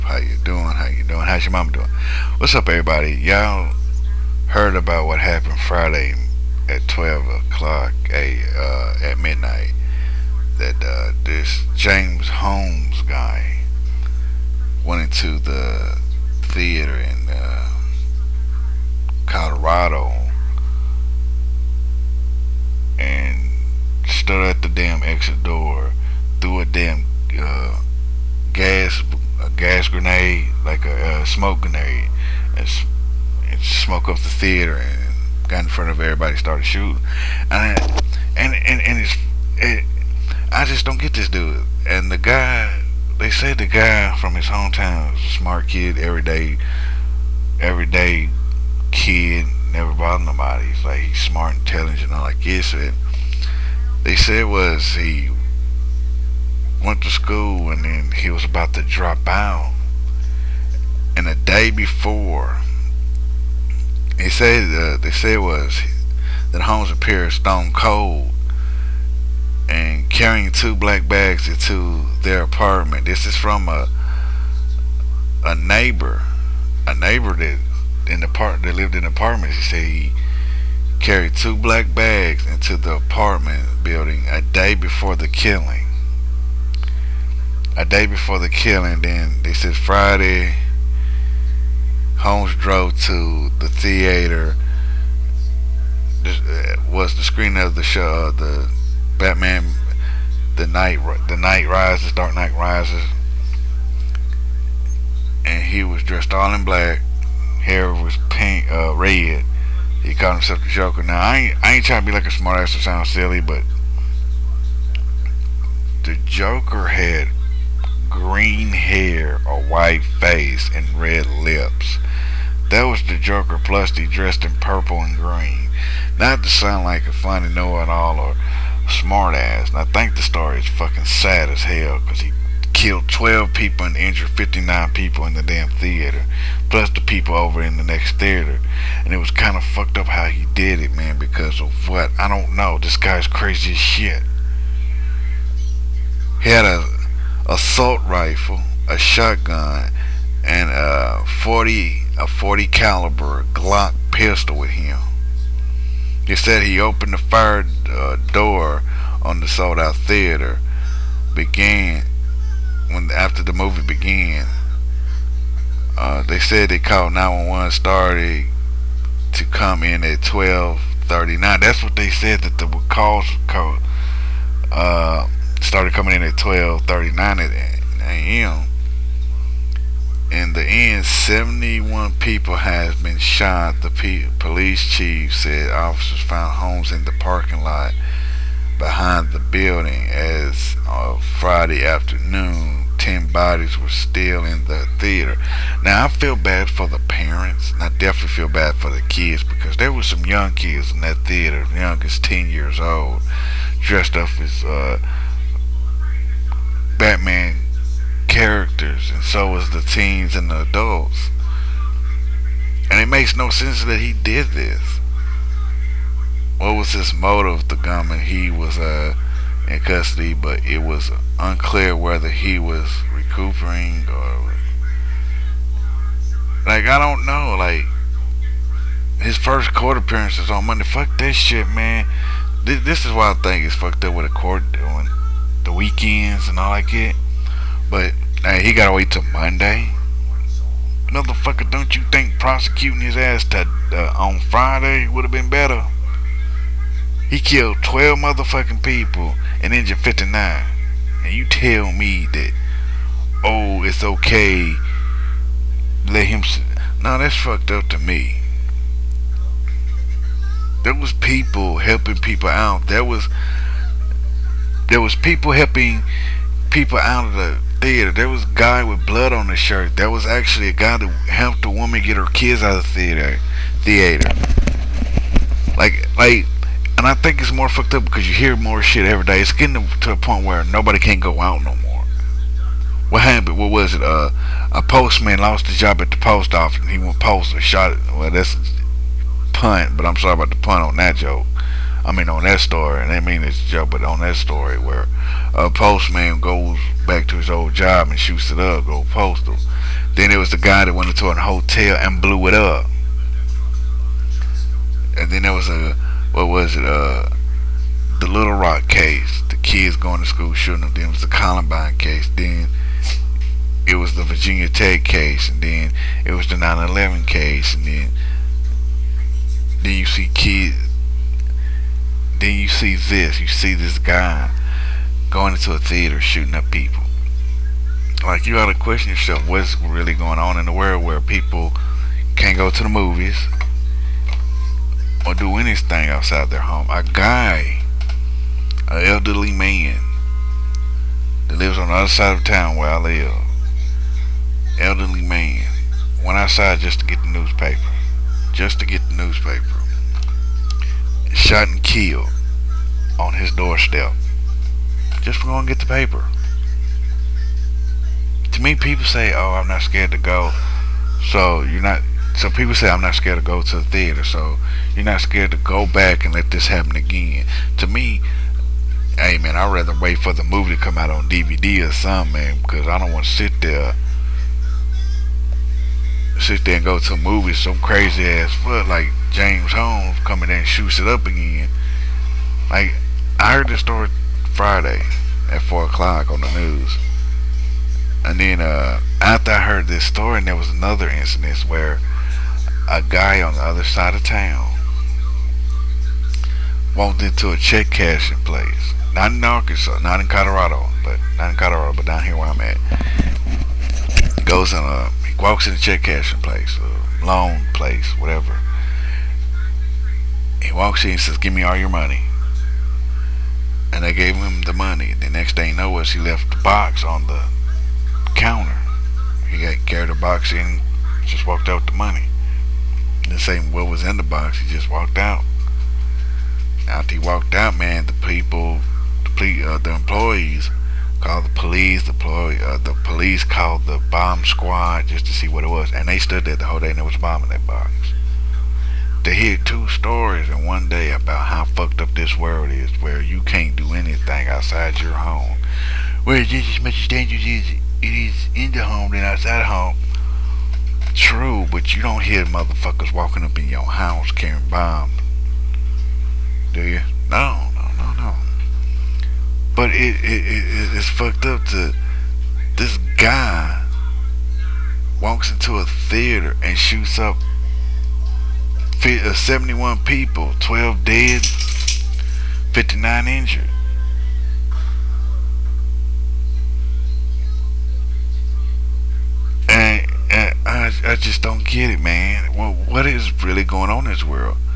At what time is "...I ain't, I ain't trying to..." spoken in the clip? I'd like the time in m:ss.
1:51.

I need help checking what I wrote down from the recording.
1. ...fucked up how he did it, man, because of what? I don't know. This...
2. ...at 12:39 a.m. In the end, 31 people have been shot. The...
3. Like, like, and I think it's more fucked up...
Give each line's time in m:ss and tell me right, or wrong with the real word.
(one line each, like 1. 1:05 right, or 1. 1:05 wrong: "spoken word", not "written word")
1. 2:19 right
2. 2:56 wrong: "71", not "31"
3. 4:35 right.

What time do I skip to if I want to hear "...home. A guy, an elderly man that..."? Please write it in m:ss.
5:36.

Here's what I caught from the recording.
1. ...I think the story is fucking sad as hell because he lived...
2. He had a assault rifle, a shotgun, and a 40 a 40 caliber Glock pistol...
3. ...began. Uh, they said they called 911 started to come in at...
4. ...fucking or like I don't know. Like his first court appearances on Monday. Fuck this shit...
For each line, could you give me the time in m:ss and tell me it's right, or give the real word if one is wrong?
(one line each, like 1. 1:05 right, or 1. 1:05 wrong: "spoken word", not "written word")
1. 2:09 wrong: "killed", not "lived"
2. 2:26 right
3. 2:43 right
4. 3:43 wrong: "recuperating", not "fucking".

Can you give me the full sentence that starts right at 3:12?
10 bodies were still in the theater.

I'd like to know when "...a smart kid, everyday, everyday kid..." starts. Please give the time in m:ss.
0:45.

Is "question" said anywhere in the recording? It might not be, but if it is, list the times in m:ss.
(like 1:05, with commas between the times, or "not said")
5:28.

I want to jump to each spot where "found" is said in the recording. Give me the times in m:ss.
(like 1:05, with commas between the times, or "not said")
3:06.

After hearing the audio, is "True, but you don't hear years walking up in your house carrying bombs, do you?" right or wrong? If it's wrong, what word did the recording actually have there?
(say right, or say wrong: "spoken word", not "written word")
wrong: "motherfuckers", not "years".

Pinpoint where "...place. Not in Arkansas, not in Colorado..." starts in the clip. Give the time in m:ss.
6:38.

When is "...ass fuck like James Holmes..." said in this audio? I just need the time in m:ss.
6:18.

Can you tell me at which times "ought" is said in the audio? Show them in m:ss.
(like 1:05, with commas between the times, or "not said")
5:28.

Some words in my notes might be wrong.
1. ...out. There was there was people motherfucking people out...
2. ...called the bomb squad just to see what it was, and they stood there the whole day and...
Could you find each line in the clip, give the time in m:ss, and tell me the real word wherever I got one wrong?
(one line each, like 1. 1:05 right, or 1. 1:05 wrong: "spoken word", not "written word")
1. 4:22 wrong: "helping", not "motherfucking"
2. 7:13 right.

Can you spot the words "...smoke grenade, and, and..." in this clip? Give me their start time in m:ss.
0:31.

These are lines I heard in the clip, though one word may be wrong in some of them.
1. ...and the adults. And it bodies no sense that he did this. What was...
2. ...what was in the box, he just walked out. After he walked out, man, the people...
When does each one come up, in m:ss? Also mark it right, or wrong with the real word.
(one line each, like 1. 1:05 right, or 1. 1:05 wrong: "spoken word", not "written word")
1. 3:30 wrong: "makes", not "bodies"
2. 7:03 right.